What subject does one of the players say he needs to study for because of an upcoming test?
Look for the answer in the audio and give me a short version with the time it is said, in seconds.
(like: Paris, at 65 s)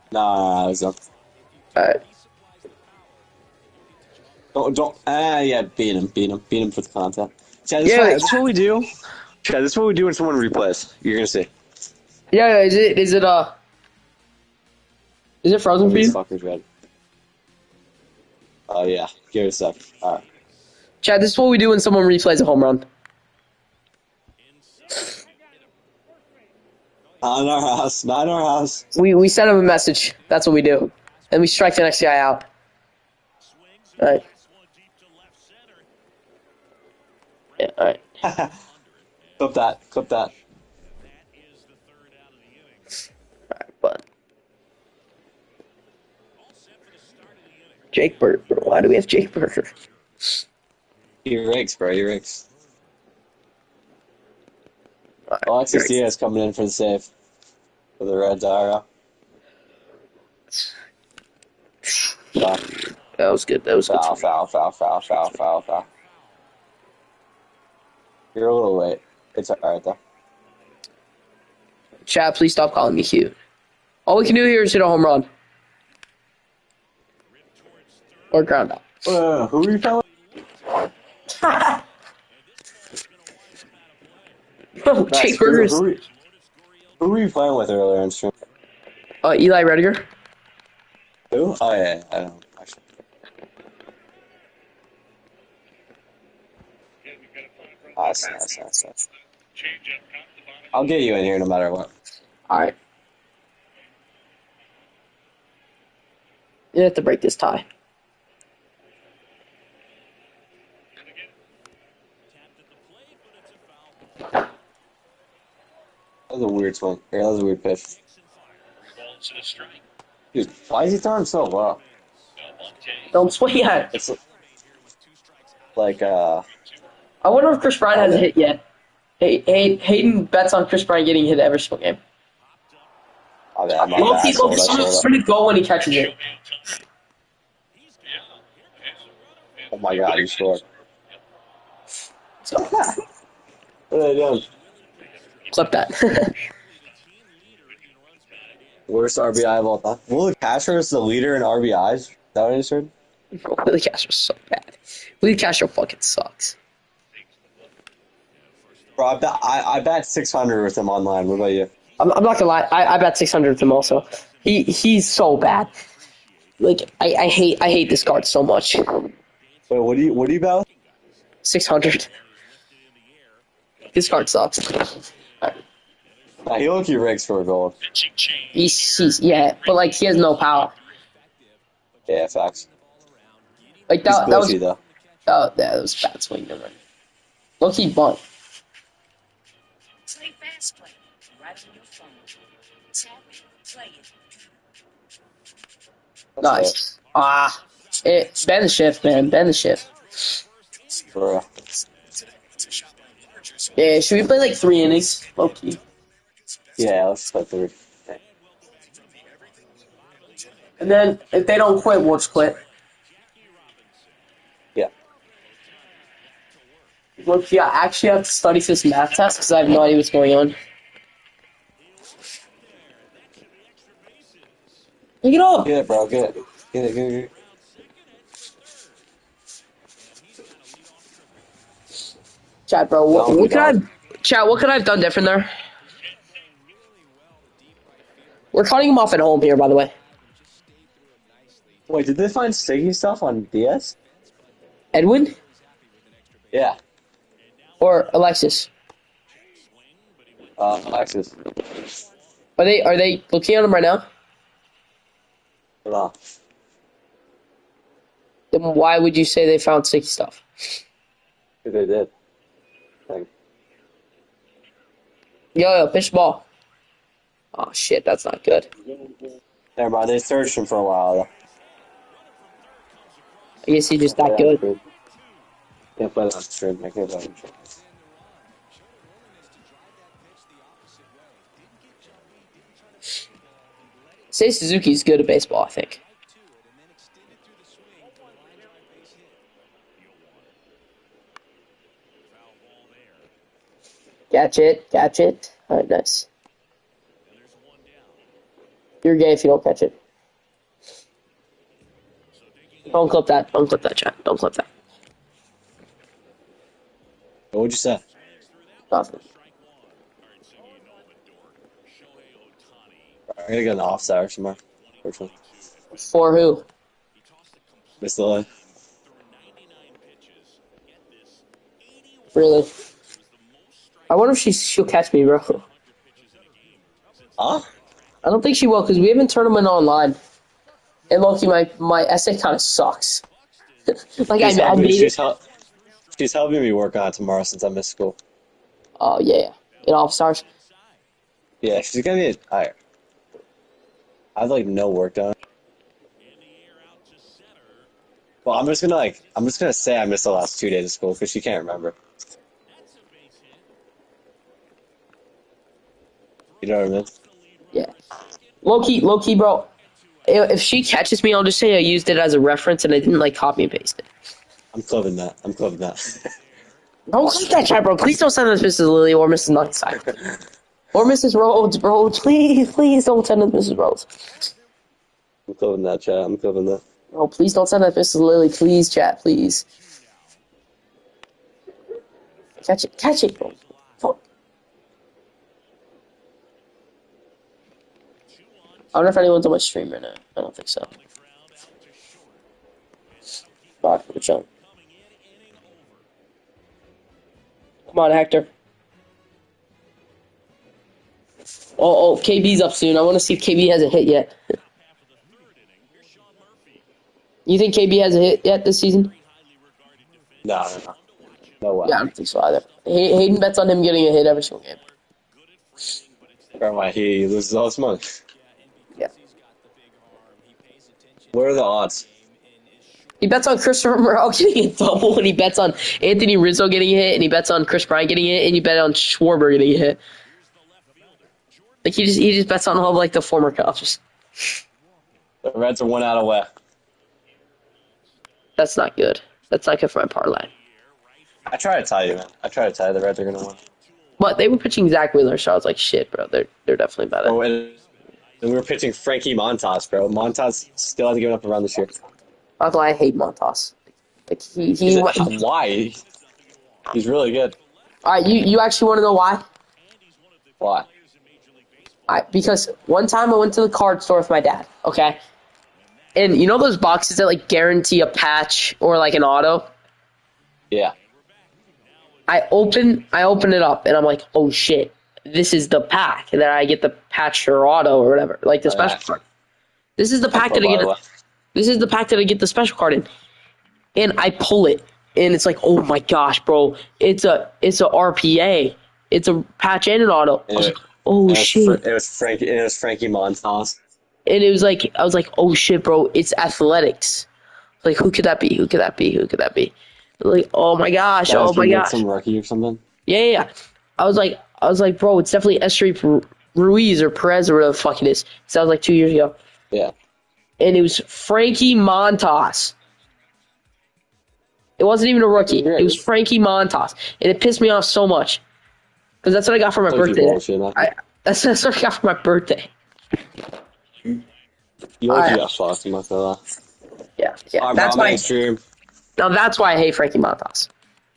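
math, at 218 s.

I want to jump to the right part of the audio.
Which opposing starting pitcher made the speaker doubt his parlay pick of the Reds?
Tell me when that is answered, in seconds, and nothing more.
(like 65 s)
444 s.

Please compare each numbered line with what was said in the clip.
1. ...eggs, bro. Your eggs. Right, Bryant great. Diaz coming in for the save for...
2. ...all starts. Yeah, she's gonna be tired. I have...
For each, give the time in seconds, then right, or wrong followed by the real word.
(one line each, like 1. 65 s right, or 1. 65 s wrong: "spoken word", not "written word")
1. 51 s wrong: "Alexis", not "Bryant"
2. 339 s right.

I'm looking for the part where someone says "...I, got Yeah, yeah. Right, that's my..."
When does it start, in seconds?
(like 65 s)
525 s.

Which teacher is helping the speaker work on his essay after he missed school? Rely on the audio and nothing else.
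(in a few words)
Miss Lily.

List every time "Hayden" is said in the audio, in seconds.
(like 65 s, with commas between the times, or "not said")
129 s, 413 s.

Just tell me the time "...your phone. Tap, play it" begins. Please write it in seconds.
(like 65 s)
191 s.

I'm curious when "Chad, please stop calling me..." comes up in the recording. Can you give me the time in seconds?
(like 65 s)
72 s.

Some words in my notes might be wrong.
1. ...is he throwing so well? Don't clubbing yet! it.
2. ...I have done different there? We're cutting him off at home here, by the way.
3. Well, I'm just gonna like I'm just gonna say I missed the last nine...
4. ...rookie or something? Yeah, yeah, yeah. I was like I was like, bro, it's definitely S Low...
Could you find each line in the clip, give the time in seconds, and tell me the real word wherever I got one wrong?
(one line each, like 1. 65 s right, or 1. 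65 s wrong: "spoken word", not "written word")
1. 120 s wrong: "swing", not "clubbing"
2. 234 s right
3. 348 s wrong: "two", not "nine"
4. 502 s wrong: "Ruiz", not "Low".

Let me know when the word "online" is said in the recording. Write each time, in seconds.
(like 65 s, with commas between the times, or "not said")
160 s, 329 s.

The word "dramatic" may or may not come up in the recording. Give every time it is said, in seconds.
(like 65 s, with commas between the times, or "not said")
not said.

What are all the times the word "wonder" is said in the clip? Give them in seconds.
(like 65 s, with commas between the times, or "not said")
127 s, 324 s, 388 s.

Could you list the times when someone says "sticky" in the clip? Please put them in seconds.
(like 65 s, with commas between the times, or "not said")
242 s, 259 s.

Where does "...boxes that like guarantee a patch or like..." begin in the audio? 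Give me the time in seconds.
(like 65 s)
466 s.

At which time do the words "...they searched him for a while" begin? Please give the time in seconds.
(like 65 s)
270 s.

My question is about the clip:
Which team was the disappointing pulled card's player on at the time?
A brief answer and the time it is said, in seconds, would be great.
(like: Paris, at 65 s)
Athletics, at 496 s.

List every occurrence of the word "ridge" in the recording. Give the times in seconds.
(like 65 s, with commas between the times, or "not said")
not said.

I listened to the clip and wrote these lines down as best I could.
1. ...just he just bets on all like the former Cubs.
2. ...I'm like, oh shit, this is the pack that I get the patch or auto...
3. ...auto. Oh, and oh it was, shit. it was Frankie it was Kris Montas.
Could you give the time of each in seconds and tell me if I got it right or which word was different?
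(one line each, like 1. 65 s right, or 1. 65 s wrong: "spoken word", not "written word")
1. 432 s right
2. 473 s right
3. 490 s wrong: "Frankie", not "Kris".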